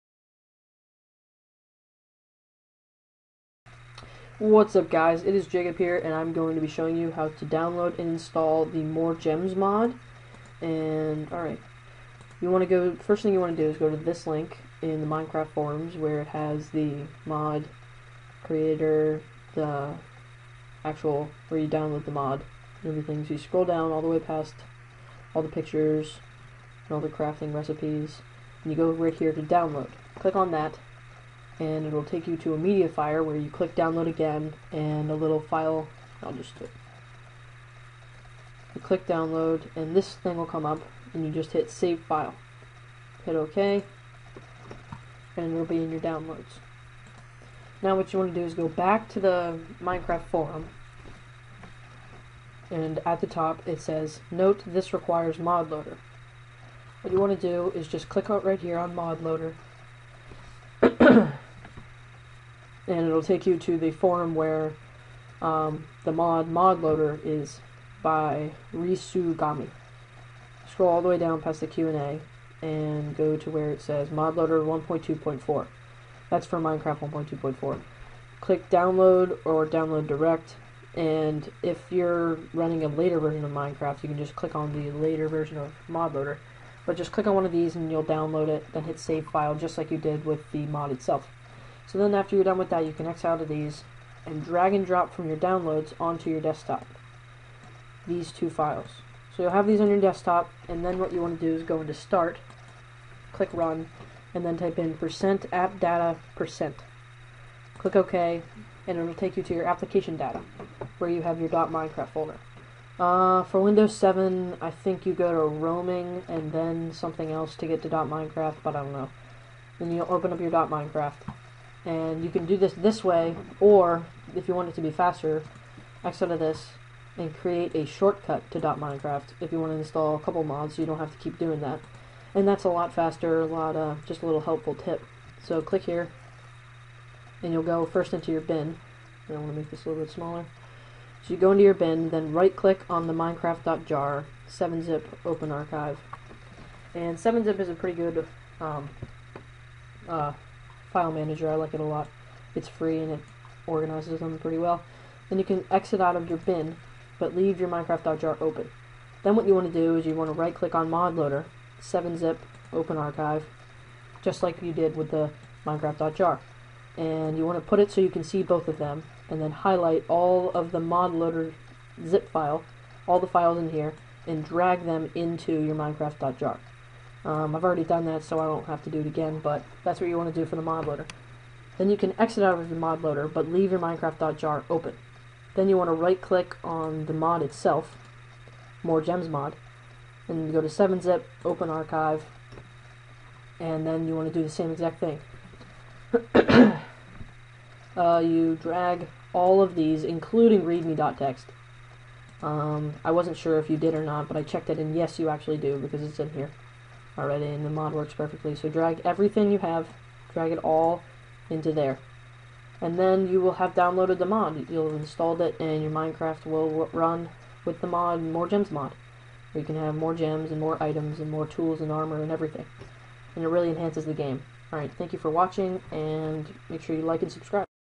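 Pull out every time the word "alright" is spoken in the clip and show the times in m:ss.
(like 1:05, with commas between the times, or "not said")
0:11, 3:44.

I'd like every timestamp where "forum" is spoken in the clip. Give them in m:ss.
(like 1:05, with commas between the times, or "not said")
0:15, 0:50, 1:03.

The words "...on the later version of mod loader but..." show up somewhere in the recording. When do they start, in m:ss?
1:24.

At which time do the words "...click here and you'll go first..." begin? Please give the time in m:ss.
2:15.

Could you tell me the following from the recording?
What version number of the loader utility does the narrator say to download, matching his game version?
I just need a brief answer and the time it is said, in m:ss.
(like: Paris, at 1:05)
1.2.4, at 1:14.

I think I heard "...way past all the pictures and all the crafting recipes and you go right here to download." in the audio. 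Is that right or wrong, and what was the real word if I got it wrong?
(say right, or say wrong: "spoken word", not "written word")
right.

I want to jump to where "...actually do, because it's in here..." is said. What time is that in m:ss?
3:25.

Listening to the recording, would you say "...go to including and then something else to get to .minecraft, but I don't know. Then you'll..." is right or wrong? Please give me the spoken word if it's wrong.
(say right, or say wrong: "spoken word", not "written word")
wrong: "roaming", not "including".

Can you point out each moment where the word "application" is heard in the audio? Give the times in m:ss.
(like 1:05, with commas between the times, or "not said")
1:49.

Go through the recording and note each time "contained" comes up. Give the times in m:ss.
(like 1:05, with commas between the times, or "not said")
not said.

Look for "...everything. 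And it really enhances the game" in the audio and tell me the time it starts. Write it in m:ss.
3:42.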